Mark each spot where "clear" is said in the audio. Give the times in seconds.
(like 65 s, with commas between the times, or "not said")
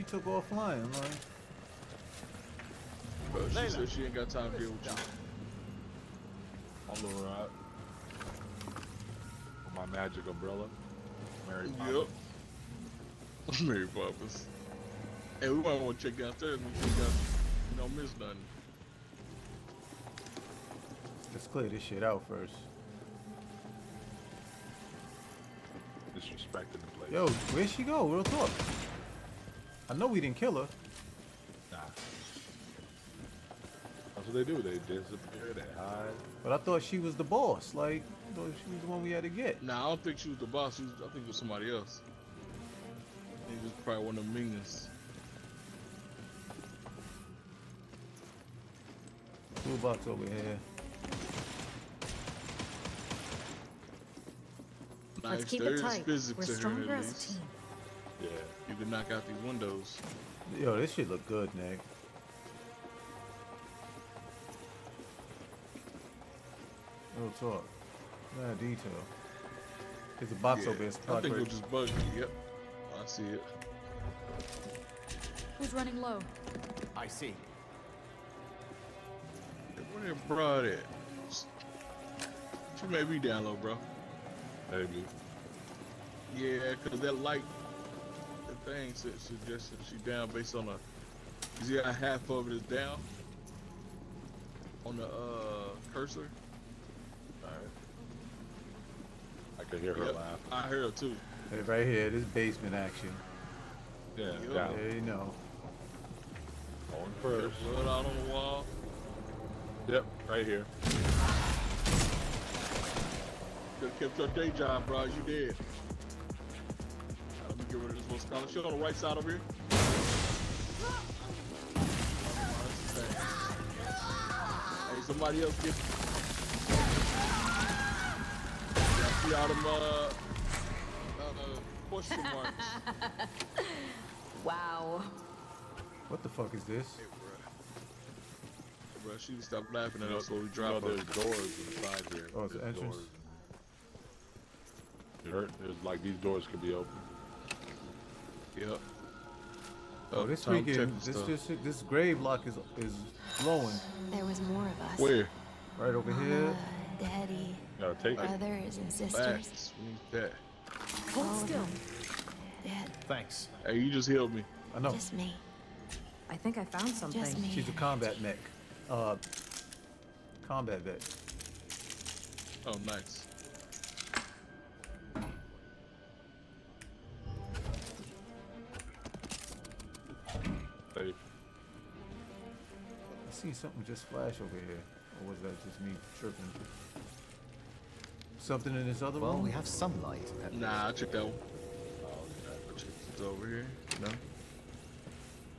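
21 s.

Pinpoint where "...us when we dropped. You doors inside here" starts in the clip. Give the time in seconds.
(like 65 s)
140 s.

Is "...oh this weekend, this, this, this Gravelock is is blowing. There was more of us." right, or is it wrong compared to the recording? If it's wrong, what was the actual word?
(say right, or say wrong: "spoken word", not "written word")
right.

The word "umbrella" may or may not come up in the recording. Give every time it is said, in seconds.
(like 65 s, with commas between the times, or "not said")
10 s.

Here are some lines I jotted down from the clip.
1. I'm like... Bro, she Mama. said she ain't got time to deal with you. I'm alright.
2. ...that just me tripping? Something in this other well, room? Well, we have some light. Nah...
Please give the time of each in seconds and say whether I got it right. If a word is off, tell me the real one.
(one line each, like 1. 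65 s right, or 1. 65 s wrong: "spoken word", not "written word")
1. 0 s wrong: "Layla", not "Mama"
2. 185 s right.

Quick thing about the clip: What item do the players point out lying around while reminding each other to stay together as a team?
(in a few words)
Toolbox.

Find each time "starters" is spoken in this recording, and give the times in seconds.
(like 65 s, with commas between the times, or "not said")
not said.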